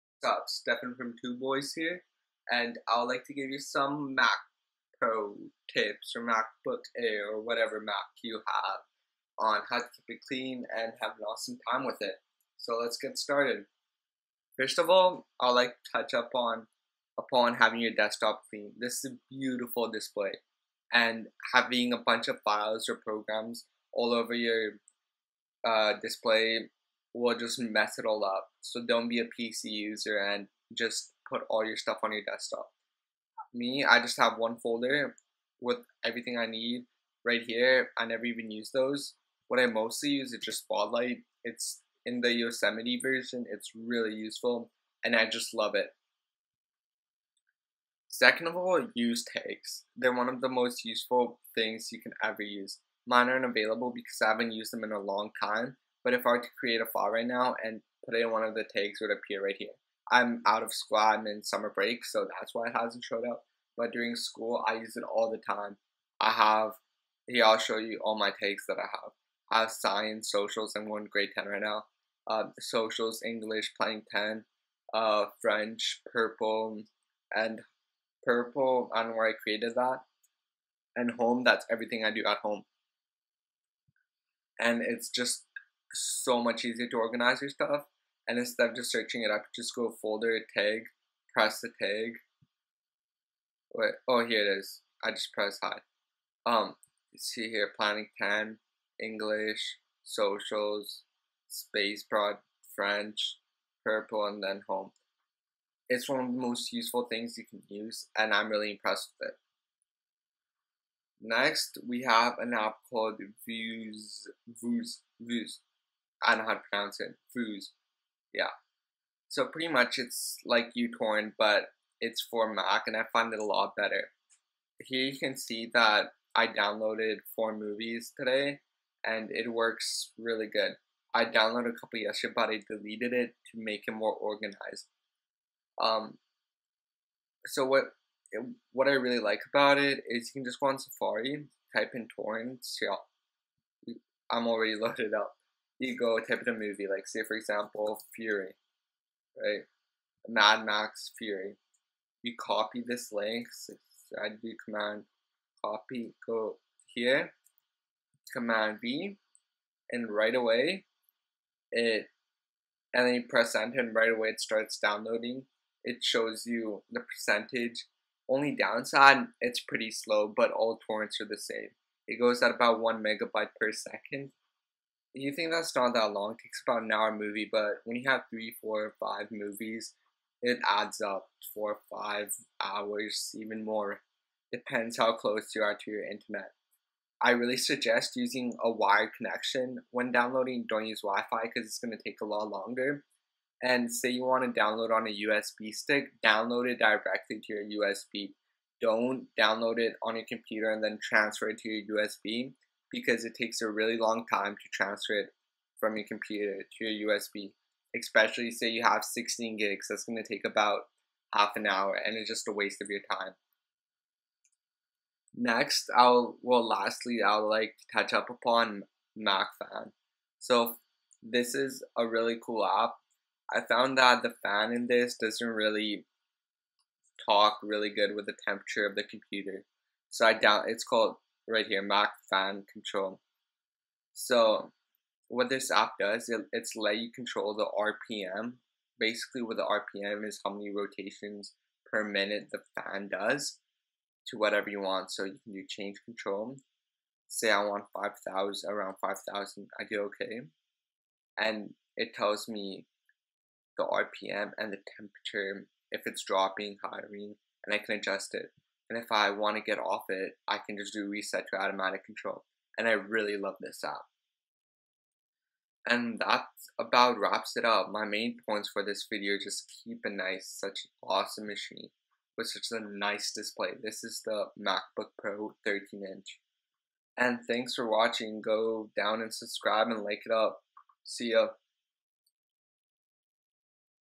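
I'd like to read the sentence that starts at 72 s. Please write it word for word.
Uh, socials, English, playing 10, uh, French, purple, and purple, I don't know where I created that.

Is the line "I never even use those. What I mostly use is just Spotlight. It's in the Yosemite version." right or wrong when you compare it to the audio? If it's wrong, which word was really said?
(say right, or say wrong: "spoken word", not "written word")
right.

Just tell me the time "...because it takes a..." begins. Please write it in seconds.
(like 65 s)
202 s.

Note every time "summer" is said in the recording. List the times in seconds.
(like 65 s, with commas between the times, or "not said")
61 s.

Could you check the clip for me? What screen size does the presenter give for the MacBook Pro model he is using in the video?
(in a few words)
13 inch.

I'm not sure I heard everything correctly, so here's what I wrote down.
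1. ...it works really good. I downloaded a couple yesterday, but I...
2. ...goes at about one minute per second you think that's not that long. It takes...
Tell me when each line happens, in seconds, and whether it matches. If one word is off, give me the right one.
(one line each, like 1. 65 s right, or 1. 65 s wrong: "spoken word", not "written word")
1. 129 s right
2. 172 s wrong: "megabyte", not "minute".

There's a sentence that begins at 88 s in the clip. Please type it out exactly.
And instead of just searching it up, just go folder, tag, press the tag.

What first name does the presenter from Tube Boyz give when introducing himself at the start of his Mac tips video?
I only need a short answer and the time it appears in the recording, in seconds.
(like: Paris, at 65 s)
Stefan, at 0 s.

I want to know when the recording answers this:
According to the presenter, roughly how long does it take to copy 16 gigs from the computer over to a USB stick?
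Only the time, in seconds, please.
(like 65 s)
211 s.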